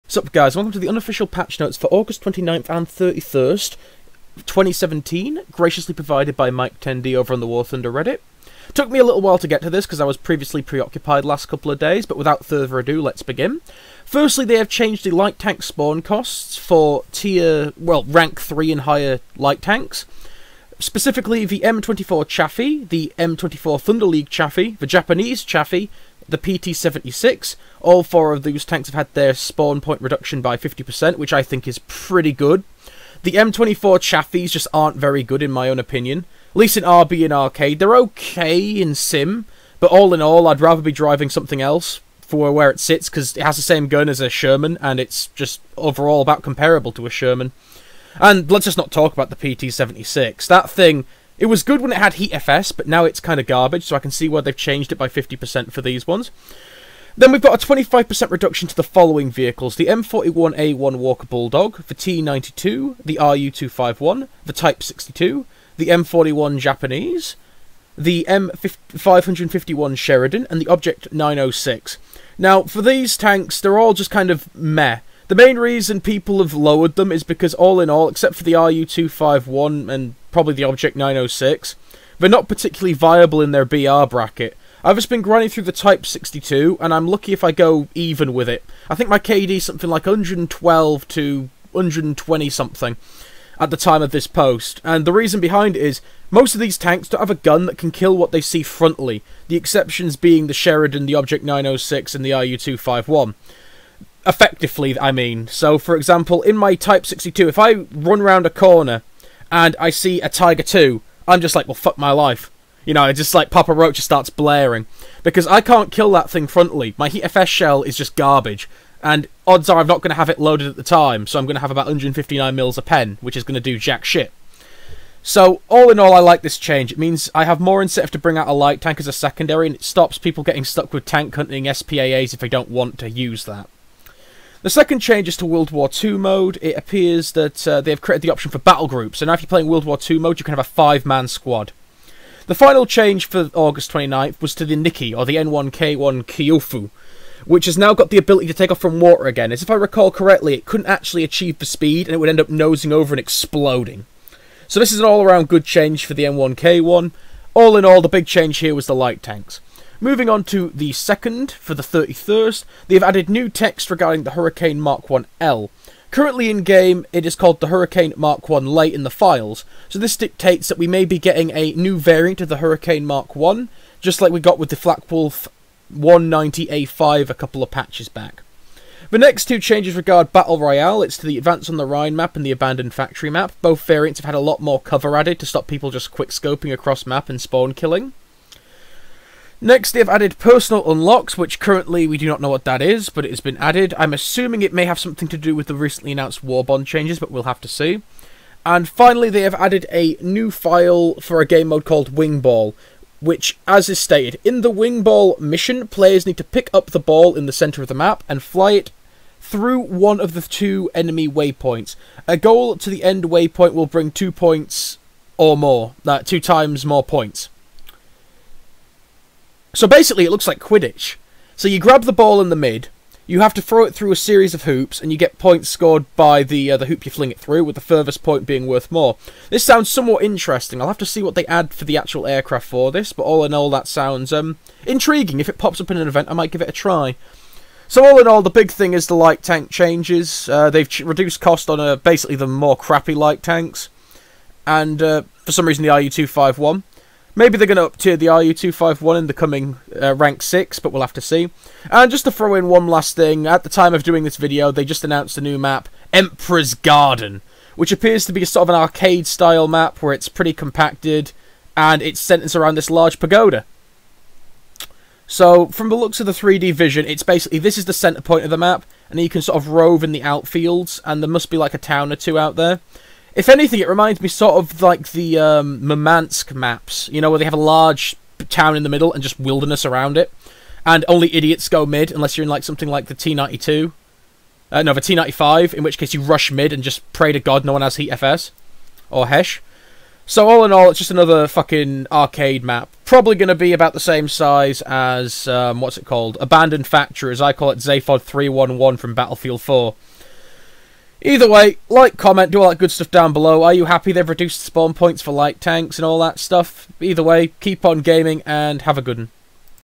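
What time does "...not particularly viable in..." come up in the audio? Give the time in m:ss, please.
1:22.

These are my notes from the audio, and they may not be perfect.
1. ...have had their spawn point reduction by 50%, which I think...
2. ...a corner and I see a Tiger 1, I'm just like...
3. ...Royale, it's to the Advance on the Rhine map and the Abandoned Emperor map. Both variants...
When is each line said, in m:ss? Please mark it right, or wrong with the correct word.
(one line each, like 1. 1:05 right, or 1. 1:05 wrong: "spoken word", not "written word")
1. 0:28 right
2. 1:48 wrong: "2", not "1"
3. 3:00 wrong: "Factory", not "Emperor".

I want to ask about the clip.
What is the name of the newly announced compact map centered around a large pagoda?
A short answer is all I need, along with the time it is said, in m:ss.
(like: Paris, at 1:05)
Emperor's Garden, at 4:16.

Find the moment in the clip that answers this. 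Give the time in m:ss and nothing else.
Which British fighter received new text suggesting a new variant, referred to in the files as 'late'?
2:44.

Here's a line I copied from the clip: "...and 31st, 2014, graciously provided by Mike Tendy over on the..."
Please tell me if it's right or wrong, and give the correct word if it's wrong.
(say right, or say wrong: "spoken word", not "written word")
wrong: "2017", not "2014".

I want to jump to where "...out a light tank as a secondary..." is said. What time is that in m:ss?
2:08.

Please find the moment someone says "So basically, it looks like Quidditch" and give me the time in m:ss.
3:39.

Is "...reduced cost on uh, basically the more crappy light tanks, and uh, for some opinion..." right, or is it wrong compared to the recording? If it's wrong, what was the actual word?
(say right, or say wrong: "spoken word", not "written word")
wrong: "reason", not "opinion".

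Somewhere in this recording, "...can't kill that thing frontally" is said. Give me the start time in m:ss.
1:55.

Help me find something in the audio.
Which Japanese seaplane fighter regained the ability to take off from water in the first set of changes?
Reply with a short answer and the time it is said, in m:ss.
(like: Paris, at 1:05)
N1K1 Kyofu, at 2:25.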